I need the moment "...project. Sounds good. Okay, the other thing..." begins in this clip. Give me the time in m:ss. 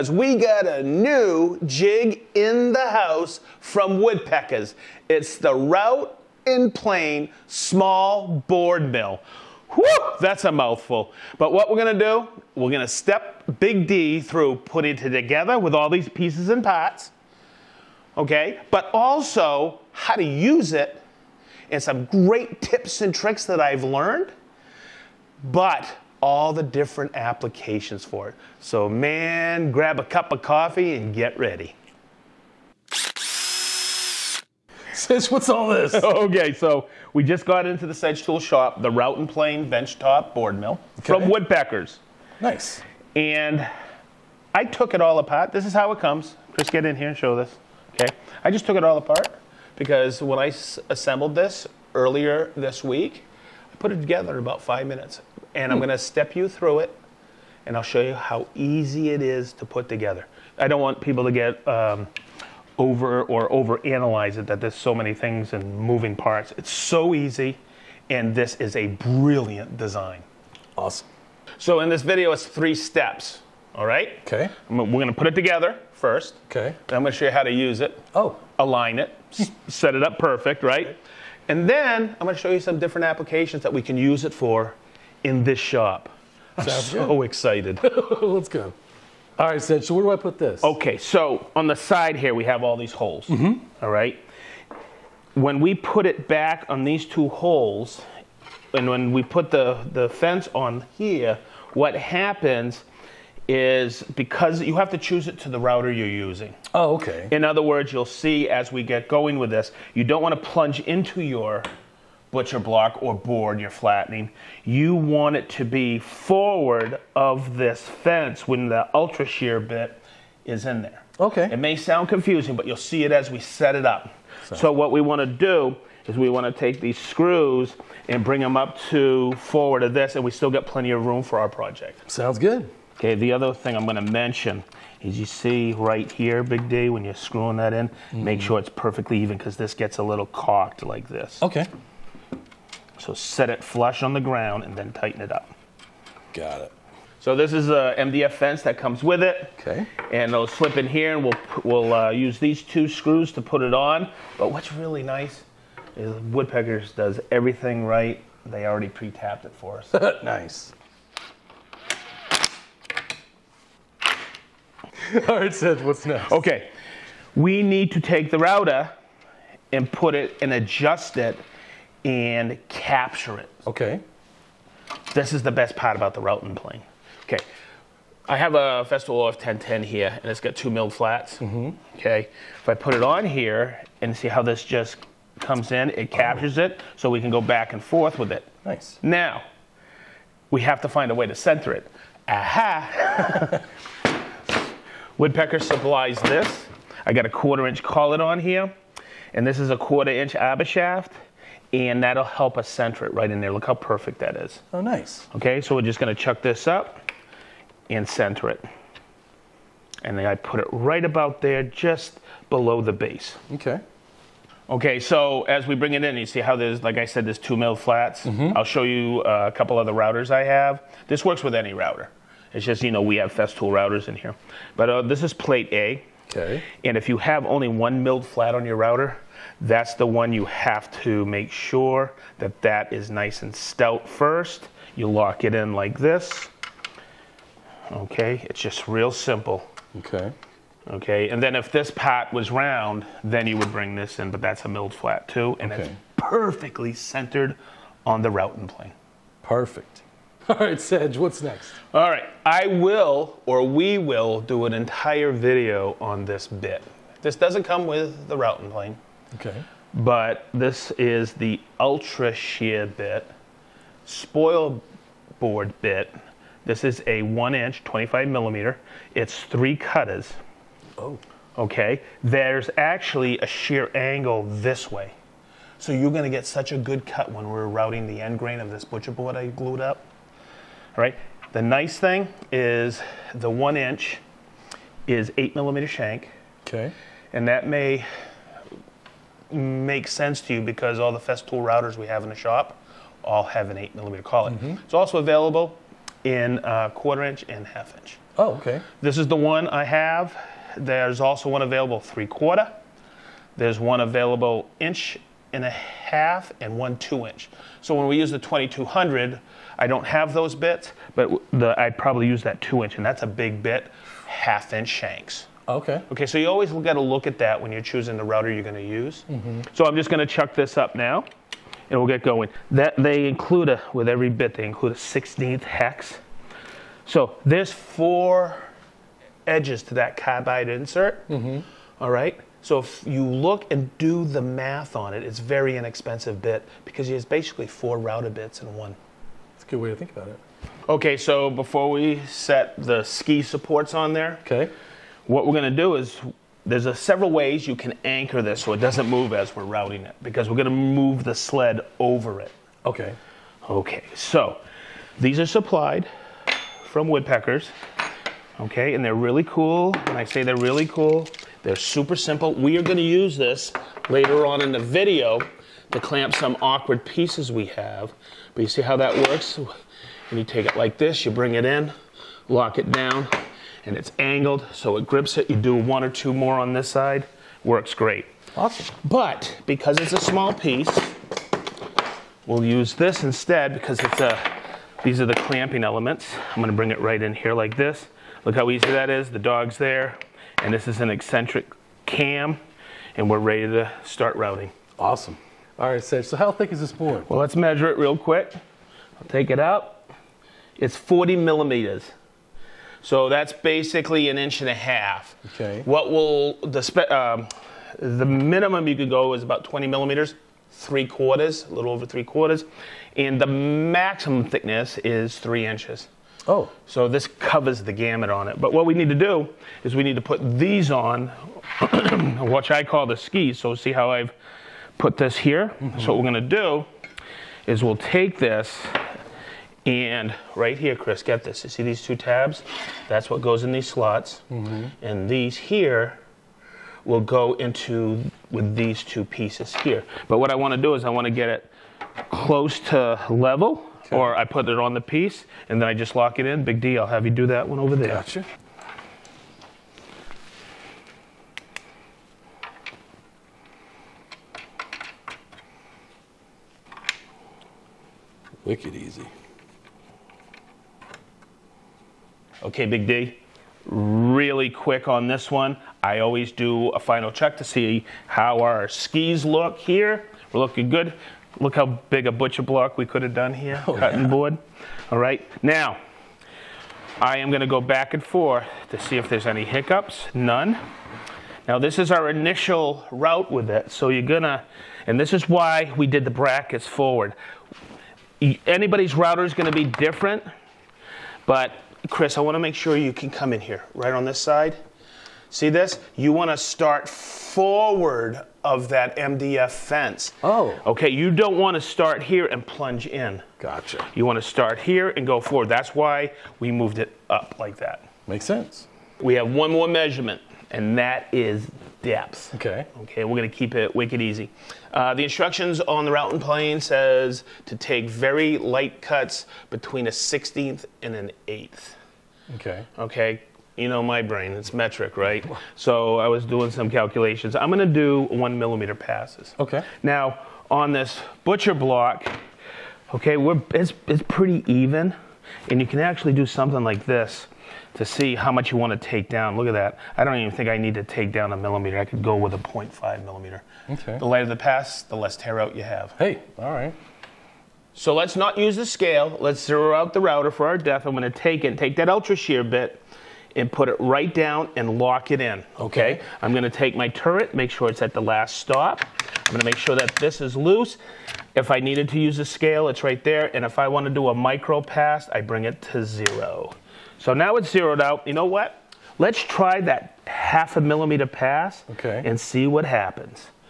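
2:11.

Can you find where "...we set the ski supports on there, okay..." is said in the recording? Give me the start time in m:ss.
5:41.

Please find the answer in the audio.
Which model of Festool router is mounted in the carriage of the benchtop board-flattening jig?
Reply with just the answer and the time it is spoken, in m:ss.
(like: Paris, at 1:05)
OF 1010, at 2:59.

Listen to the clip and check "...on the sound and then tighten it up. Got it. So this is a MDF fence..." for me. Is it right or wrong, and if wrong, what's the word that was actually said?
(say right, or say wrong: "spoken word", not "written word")
wrong: "ground", not "sound".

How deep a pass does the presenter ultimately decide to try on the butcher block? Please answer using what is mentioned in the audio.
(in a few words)
0.5 millimeter.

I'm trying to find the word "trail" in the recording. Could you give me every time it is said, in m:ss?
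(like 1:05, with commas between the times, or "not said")
not said.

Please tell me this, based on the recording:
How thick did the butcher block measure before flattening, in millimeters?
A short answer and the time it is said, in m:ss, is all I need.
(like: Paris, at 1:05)
40 millimeters, at 6:40.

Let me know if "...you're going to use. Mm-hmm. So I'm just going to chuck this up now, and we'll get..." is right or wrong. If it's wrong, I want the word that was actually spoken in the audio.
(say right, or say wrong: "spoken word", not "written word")
right.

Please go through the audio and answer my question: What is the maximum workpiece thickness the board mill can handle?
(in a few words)
3 inches.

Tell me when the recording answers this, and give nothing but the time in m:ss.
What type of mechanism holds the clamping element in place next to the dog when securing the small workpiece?
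6:31.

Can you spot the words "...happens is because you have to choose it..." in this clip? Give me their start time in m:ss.
1:41.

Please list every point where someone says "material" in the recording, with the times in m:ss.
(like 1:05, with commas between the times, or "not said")
not said.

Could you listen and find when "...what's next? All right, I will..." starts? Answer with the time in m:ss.
4:11.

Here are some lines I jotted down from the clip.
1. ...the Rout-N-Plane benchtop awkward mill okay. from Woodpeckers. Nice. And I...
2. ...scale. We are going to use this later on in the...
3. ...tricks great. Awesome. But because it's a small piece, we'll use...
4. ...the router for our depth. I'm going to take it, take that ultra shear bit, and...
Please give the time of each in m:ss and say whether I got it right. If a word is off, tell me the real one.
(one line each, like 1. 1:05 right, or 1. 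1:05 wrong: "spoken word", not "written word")
1. 0:38 wrong: "board", not "awkward"
2. 6:02 wrong: "simple", not "scale"
3. 6:17 wrong: "works", not "tricks"
4. 9:10 right.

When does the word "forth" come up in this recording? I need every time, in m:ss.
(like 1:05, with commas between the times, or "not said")
3:07, 7:58.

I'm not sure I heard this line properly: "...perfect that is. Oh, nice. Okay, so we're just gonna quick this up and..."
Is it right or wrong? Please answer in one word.
wrong.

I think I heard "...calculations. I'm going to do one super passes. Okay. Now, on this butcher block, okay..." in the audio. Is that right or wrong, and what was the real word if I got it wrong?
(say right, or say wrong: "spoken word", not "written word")
wrong: "millimeter", not "super".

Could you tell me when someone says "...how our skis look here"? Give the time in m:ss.
7:48.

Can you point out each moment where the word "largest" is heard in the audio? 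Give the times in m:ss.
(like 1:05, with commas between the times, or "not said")
not said.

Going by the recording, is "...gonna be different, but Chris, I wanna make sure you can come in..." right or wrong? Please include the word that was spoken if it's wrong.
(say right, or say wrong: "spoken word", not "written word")
right.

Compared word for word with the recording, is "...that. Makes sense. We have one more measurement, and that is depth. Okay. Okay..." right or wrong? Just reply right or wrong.
right.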